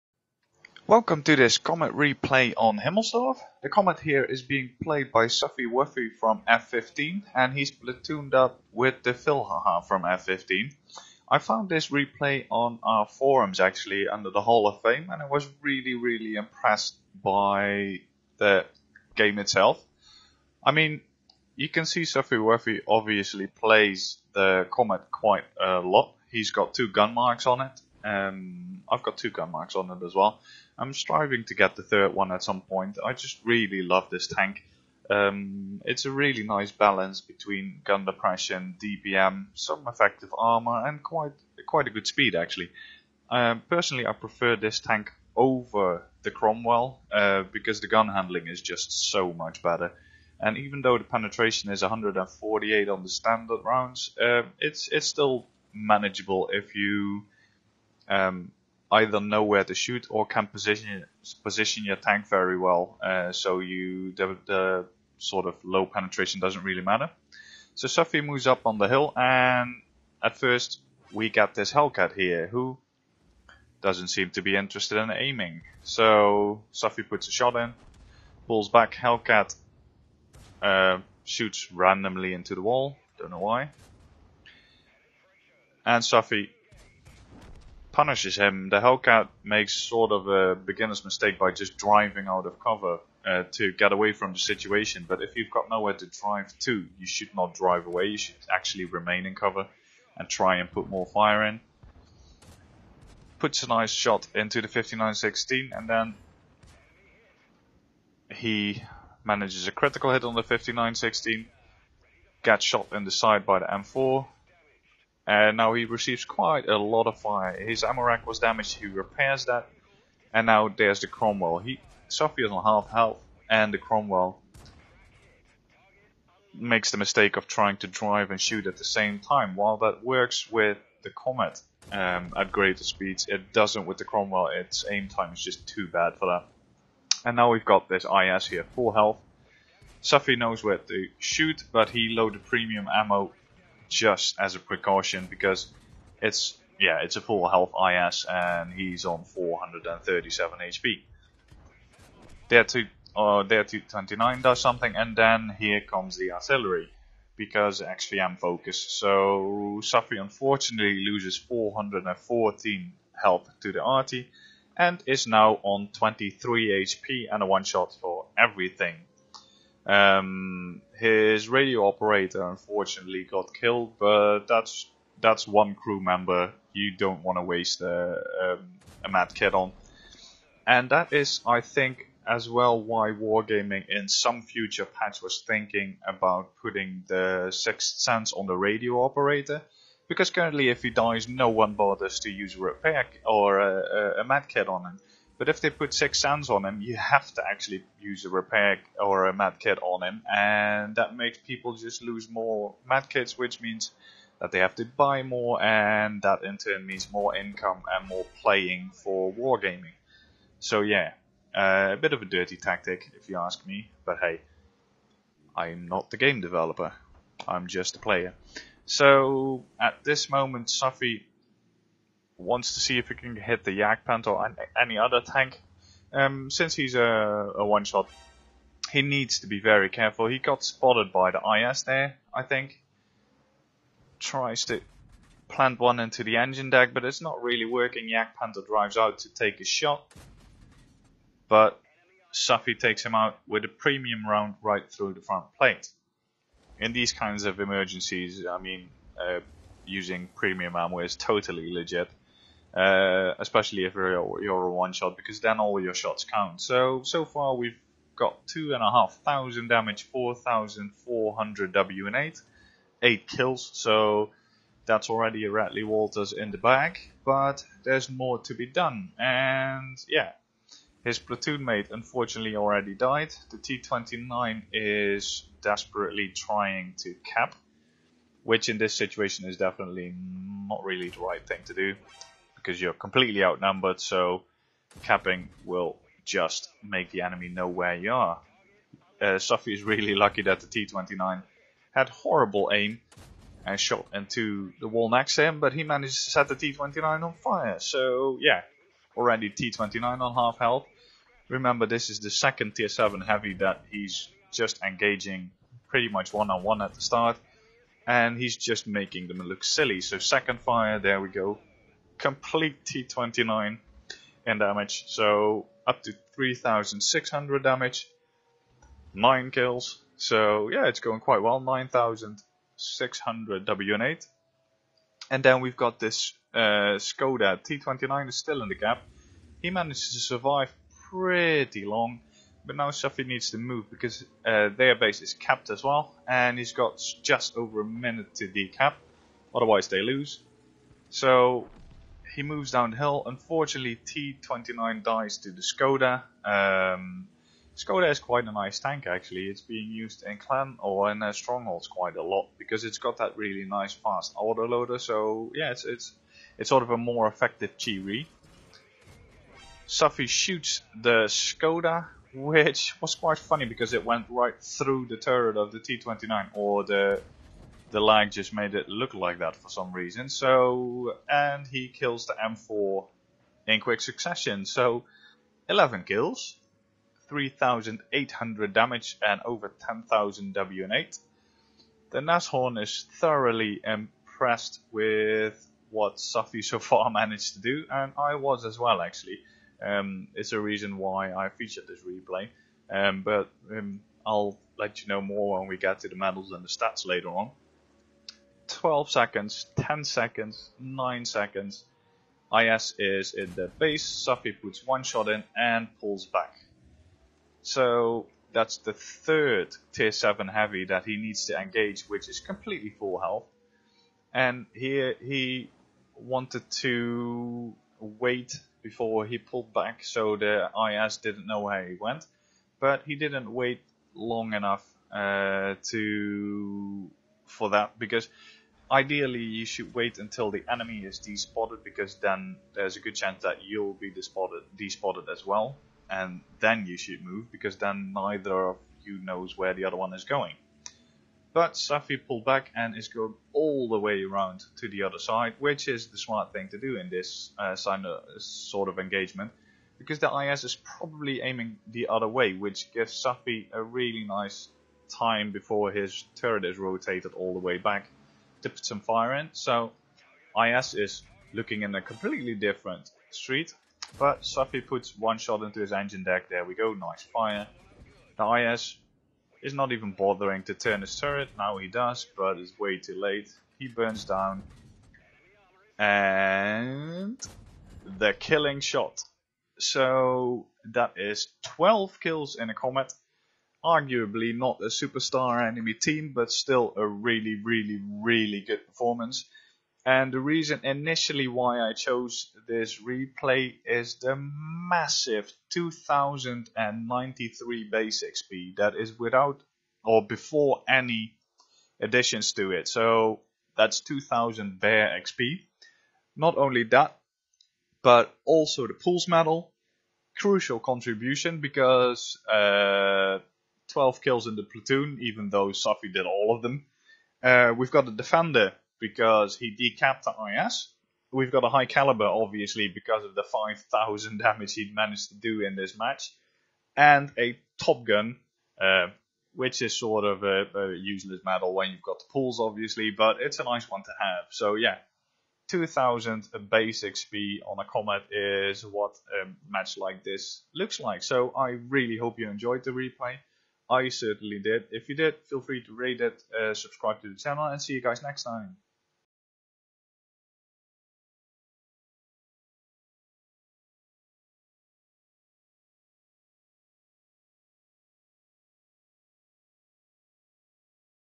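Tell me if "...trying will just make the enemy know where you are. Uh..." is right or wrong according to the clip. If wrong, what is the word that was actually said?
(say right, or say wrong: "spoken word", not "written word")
wrong: "capping", not "trying".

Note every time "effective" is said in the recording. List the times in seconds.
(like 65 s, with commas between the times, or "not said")
39 s, 357 s.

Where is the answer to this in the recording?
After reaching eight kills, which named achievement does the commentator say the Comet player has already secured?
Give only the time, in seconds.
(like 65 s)
265 s.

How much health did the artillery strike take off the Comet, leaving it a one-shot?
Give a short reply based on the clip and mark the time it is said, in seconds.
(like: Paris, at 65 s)
414, at 161 s.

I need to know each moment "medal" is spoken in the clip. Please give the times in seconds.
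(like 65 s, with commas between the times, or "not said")
396 s, 509 s, 531 s.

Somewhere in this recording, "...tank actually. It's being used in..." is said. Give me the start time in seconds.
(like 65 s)
348 s.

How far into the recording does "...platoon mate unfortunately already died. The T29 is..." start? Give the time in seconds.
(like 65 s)
271 s.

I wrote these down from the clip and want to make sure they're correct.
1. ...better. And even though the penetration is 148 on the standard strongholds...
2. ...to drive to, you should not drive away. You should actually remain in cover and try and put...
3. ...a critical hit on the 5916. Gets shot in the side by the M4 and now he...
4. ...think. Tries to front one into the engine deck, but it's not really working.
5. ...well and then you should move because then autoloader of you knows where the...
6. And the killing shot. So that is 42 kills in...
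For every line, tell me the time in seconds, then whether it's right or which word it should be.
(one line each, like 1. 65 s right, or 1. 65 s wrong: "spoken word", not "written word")
1. 49 s wrong: "rounds", not "strongholds"
2. 95 s right
3. 109 s right
4. 232 s wrong: "plant", not "front"
5. 435 s wrong: "neither", not "autoloader"
6. 475 s wrong: "12", not "42".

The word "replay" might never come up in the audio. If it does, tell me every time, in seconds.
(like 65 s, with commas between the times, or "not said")
1 s, 11 s, 392 s, 493 s, 542 s.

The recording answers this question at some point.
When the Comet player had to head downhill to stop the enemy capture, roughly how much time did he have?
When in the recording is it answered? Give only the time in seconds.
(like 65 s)
337 s.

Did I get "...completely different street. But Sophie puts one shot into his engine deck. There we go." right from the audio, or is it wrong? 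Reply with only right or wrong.
right.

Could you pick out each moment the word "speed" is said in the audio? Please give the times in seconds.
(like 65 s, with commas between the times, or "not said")
42 s, 132 s.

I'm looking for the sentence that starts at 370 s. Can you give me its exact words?
So, and he kills the M4 in quick succession.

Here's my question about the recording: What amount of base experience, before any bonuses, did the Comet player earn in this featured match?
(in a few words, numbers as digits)
2093.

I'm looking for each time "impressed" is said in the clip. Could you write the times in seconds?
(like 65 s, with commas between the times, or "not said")
16 s, 383 s.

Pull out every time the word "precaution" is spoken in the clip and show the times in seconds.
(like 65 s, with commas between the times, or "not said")
144 s.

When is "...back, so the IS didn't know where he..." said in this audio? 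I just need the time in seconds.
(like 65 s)
419 s.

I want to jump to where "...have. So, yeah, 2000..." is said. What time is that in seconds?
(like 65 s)
534 s.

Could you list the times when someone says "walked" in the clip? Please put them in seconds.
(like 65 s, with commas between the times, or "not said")
not said.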